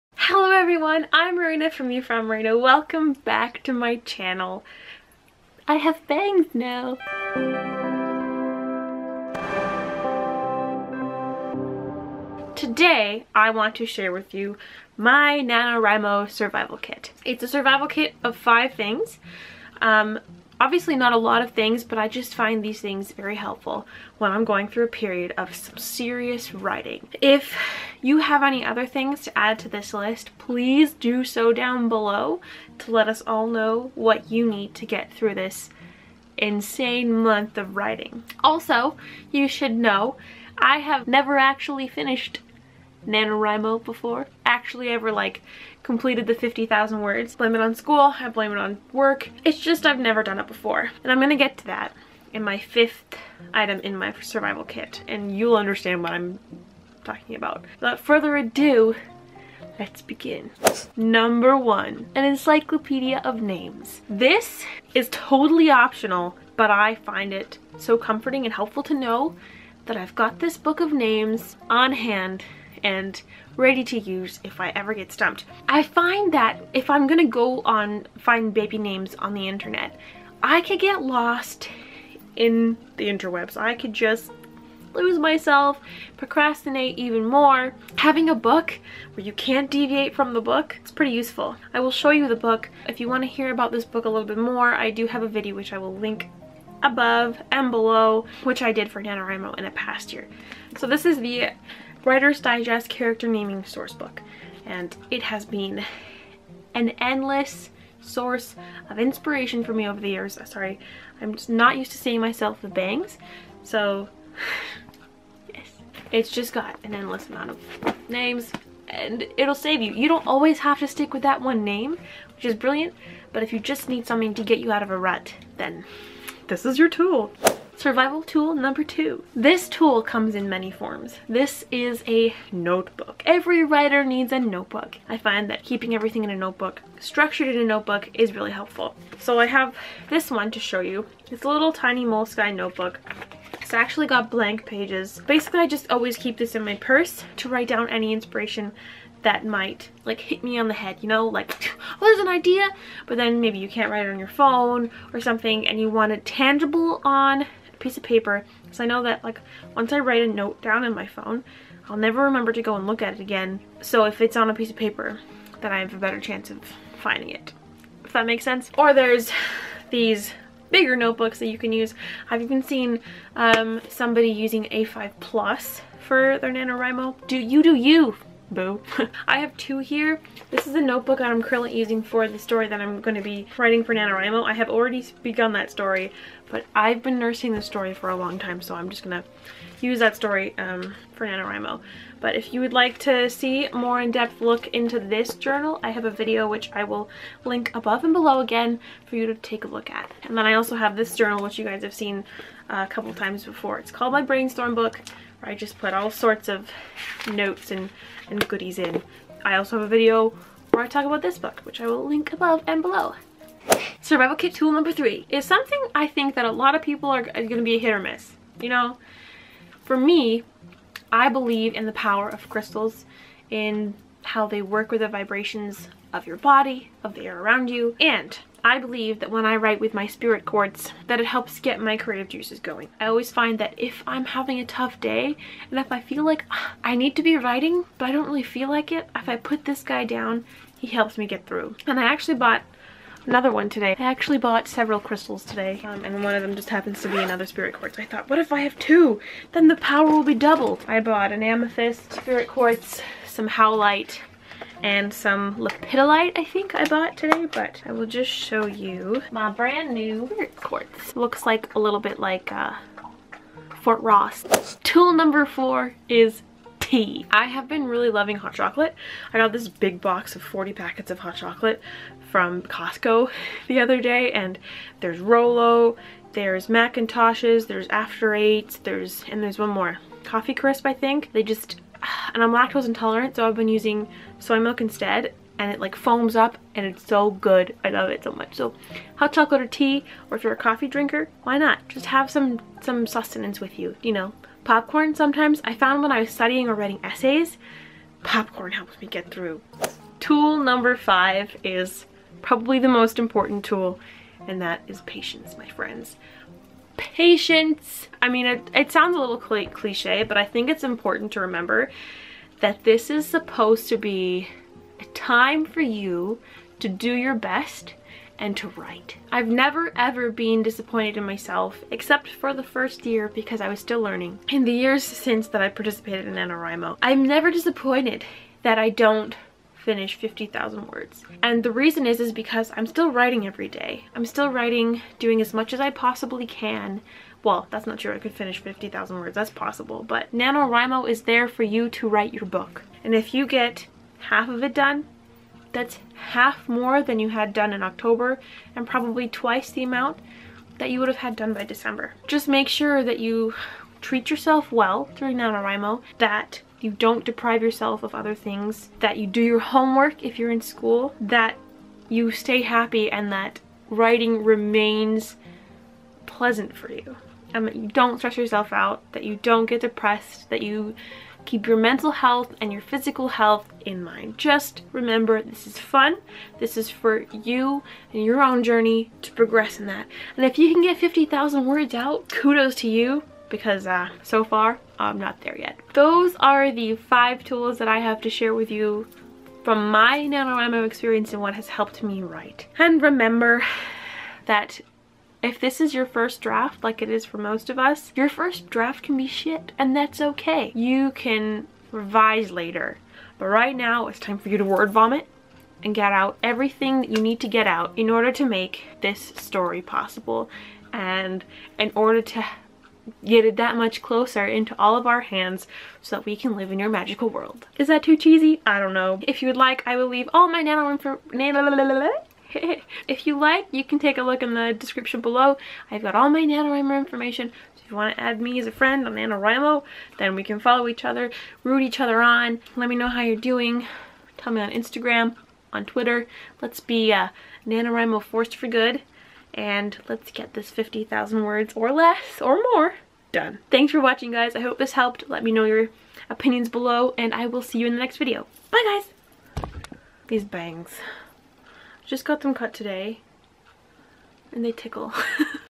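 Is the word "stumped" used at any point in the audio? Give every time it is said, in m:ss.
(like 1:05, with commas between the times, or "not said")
1:15.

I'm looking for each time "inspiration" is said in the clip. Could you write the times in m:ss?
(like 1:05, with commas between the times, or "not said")
1:48, 2:28.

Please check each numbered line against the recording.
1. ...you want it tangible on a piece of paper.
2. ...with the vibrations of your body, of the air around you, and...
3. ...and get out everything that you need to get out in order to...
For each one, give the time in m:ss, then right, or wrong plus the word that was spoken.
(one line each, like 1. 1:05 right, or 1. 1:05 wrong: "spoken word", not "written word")
1. 2:35 right
2. 3:44 right
3. 6:45 right.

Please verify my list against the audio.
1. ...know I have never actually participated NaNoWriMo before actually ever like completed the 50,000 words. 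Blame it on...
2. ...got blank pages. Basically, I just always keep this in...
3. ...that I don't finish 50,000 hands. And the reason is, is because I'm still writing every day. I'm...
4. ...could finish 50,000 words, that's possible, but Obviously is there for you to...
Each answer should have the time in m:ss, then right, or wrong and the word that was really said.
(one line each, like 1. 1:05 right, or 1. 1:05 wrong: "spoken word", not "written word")
1. 0:39 wrong: "finished", not "participated"
2. 2:24 right
3. 5:28 wrong: "words", not "hands"
4. 5:38 wrong: "NaNoWriMo", not "Obviously".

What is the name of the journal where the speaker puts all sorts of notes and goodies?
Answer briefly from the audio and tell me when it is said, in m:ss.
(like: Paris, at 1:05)
My Brainstorm Book, at 3:24.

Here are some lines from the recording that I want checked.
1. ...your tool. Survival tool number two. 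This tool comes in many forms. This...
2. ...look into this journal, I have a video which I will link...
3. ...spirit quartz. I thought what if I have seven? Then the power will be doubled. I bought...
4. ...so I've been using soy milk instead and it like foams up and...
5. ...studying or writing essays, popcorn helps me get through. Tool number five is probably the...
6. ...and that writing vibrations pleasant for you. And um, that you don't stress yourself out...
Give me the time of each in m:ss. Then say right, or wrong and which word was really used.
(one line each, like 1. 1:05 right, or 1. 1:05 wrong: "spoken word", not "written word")
1. 2:06 right
2. 3:14 right
3. 4:07 wrong: "two", not "seven"
4. 4:43 right
5. 4:56 right
6. 6:03 wrong: "remains", not "vibrations".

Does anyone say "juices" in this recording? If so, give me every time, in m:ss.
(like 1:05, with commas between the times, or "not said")
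3:52.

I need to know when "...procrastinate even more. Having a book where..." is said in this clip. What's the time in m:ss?
1:26.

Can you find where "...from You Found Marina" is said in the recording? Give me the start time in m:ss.
0:01.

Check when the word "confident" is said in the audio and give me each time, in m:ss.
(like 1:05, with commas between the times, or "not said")
not said.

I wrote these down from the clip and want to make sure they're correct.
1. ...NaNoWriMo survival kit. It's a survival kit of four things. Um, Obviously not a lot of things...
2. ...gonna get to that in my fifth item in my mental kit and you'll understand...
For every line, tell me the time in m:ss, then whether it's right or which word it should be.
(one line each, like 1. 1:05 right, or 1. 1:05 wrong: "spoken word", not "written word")
1. 0:15 wrong: "five", not "four"
2. 0:51 wrong: "survival", not "mental".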